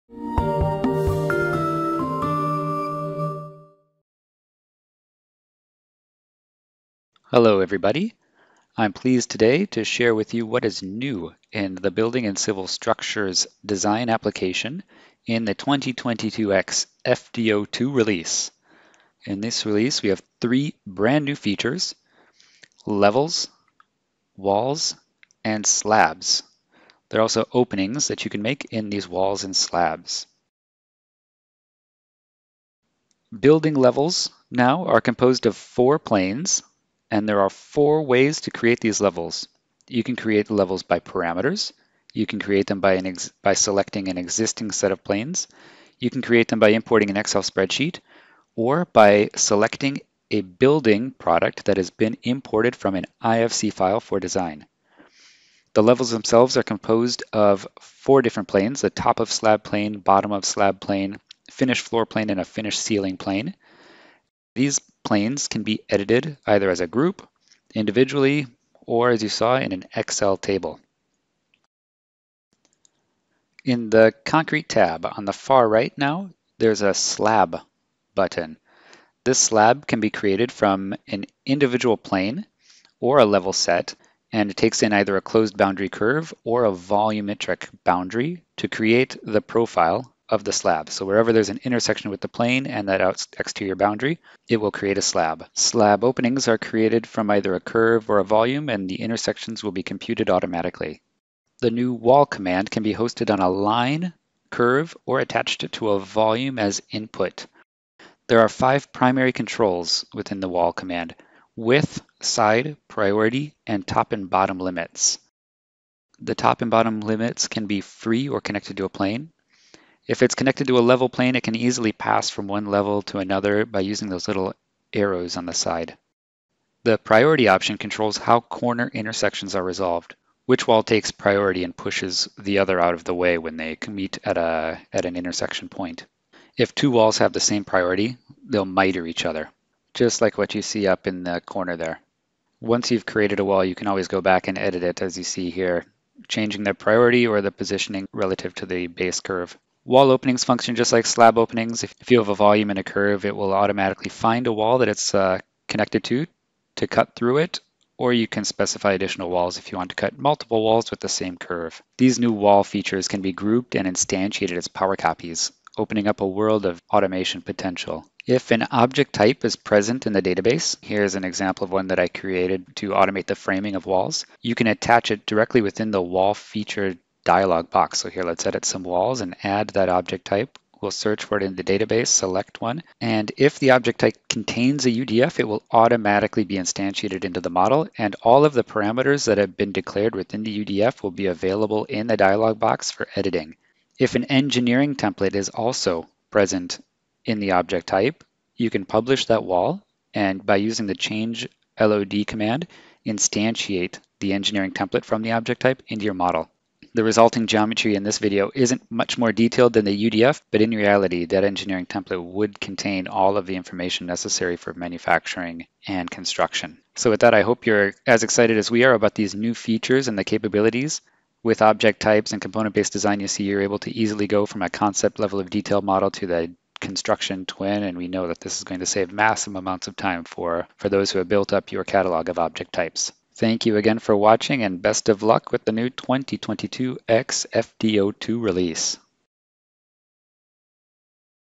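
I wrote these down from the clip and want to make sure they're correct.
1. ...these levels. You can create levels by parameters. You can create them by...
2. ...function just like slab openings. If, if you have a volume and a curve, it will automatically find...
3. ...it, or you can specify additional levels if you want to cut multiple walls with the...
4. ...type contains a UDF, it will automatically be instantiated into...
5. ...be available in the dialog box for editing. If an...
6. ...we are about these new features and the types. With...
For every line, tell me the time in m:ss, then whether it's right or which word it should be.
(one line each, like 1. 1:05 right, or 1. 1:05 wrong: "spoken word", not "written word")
1. 0:38 right
2. 2:30 right
3. 2:37 wrong: "walls", not "levels"
4. 3:03 right
5. 3:11 right
6. 3:38 wrong: "capabilities", not "types".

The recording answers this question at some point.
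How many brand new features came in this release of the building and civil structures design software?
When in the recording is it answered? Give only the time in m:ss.
0:20.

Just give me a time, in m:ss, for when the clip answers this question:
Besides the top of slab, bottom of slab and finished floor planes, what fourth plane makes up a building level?
1:02.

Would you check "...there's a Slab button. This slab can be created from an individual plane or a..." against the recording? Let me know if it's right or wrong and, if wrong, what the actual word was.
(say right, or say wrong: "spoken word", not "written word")
right.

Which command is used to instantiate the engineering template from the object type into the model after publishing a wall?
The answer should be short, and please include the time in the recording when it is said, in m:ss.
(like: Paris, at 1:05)
Change LOD, at 3:20.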